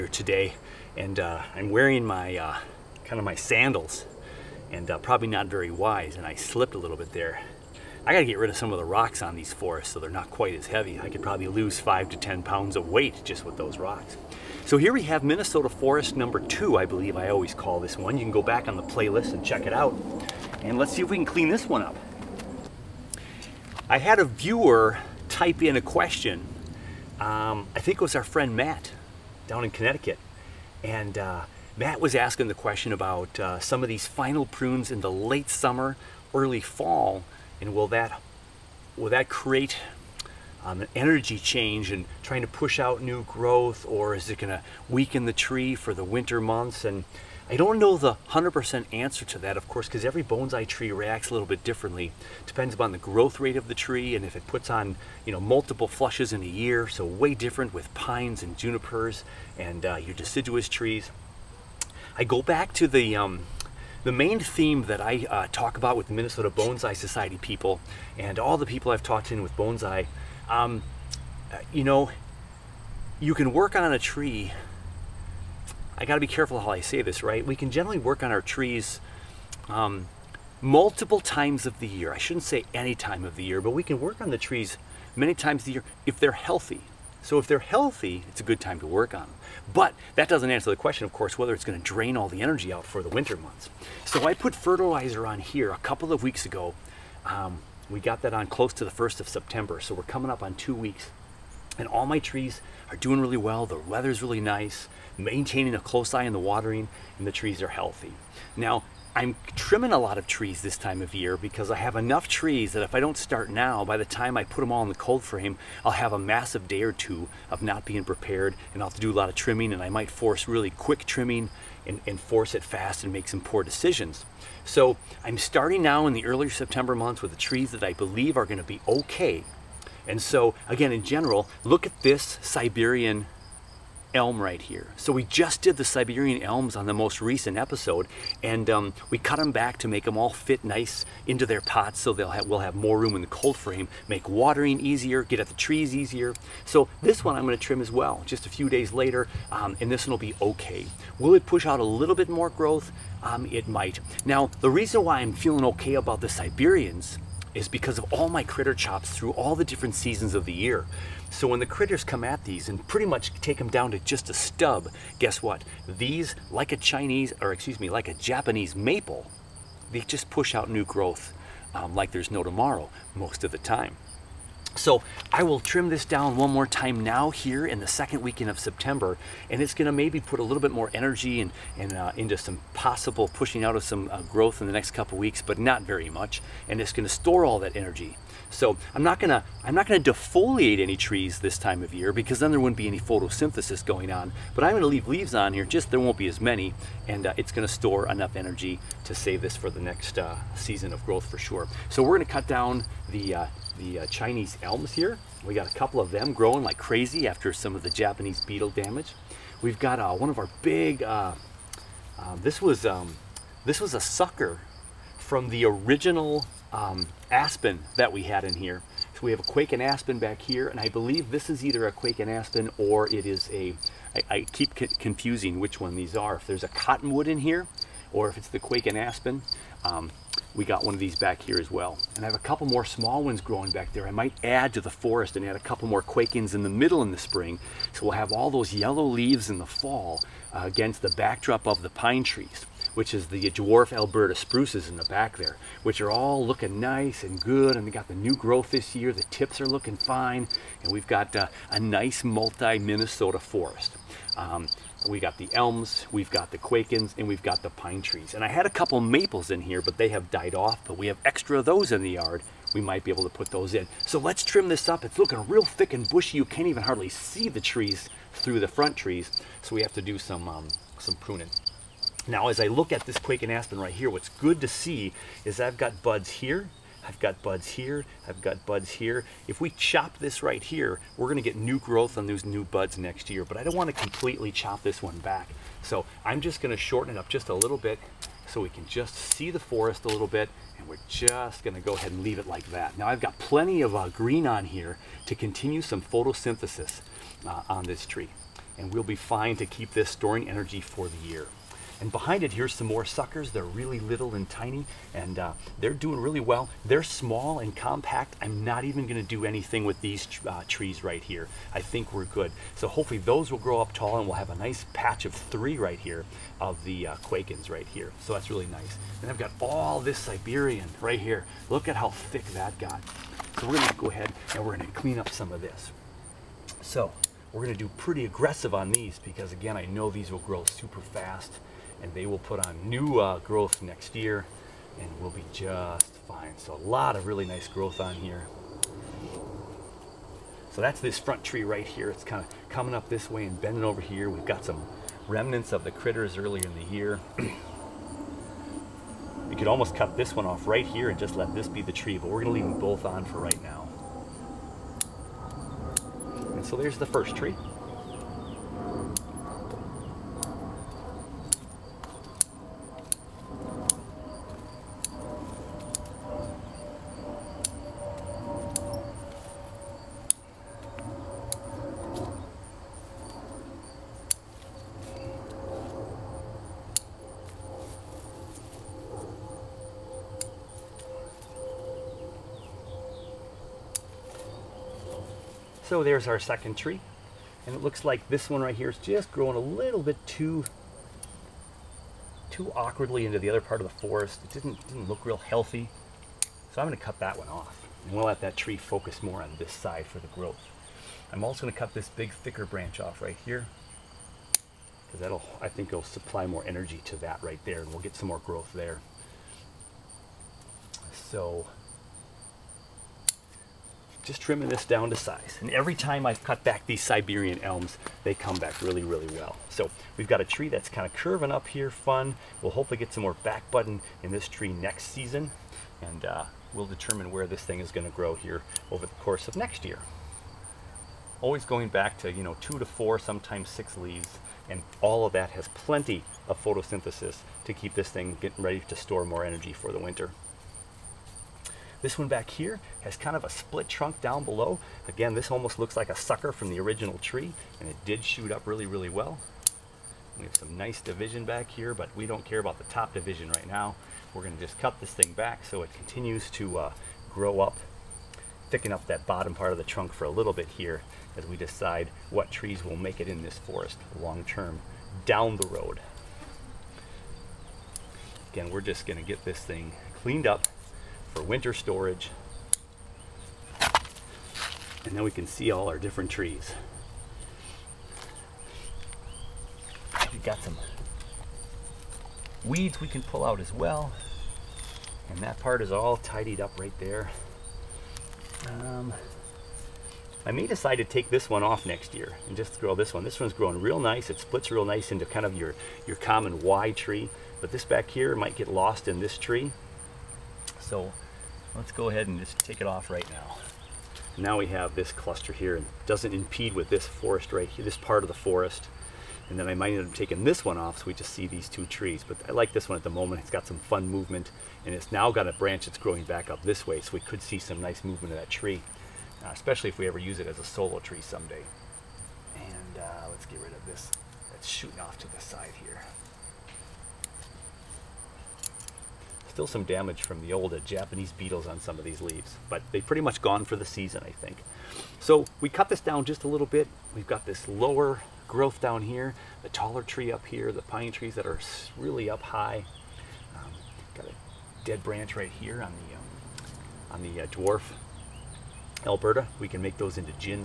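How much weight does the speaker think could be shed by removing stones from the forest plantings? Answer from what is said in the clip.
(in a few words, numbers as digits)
5 to 10 pounds.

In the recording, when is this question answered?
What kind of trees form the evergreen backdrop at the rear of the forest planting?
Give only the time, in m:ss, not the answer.
4:03.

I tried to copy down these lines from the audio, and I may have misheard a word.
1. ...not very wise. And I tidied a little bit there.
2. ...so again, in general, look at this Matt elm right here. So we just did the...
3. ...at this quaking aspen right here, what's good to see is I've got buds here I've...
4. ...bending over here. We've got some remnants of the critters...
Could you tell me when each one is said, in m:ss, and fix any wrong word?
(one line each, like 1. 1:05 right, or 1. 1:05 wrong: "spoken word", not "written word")
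1. 0:05 wrong: "slipped", not "tidied"
2. 2:10 wrong: "Siberian", not "Matt"
3. 4:32 right
4. 5:43 right.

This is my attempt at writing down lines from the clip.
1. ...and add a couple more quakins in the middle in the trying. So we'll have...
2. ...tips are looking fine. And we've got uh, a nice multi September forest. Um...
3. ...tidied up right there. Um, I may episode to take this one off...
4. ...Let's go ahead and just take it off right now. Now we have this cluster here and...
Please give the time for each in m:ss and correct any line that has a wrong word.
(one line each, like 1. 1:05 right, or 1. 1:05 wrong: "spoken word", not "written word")
1. 3:55 wrong: "spring", not "trying"
2. 4:09 wrong: "Minnesota", not "September"
3. 8:06 wrong: "decide", not "episode"
4. 8:21 right.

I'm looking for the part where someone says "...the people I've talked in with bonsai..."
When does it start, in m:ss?
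1:08.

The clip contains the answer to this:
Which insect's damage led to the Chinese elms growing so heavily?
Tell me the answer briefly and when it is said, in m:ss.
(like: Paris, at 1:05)
Japanese beetle, at 3:27.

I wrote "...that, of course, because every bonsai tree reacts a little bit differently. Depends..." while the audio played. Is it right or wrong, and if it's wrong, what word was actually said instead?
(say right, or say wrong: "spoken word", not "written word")
right.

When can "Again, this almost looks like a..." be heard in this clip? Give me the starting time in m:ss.
7:25.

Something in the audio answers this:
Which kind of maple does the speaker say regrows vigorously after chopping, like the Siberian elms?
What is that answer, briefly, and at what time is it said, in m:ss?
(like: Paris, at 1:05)
Japanese maple, at 2:48.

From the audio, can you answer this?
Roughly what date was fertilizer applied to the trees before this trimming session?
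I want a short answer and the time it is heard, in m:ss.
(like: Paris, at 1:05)
September 1, at 1:38.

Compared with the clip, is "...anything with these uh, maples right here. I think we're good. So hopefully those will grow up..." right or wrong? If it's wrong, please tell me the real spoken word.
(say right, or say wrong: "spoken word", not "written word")
wrong: "trees", not "maples".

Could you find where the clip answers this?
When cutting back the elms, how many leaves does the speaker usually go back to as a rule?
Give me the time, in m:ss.
7:12.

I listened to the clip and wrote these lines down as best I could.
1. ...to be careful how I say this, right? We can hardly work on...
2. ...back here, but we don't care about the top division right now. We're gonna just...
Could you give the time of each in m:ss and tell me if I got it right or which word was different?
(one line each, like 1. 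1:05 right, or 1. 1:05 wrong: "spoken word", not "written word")
1. 1:16 wrong: "generally", not "hardly"
2. 7:31 right.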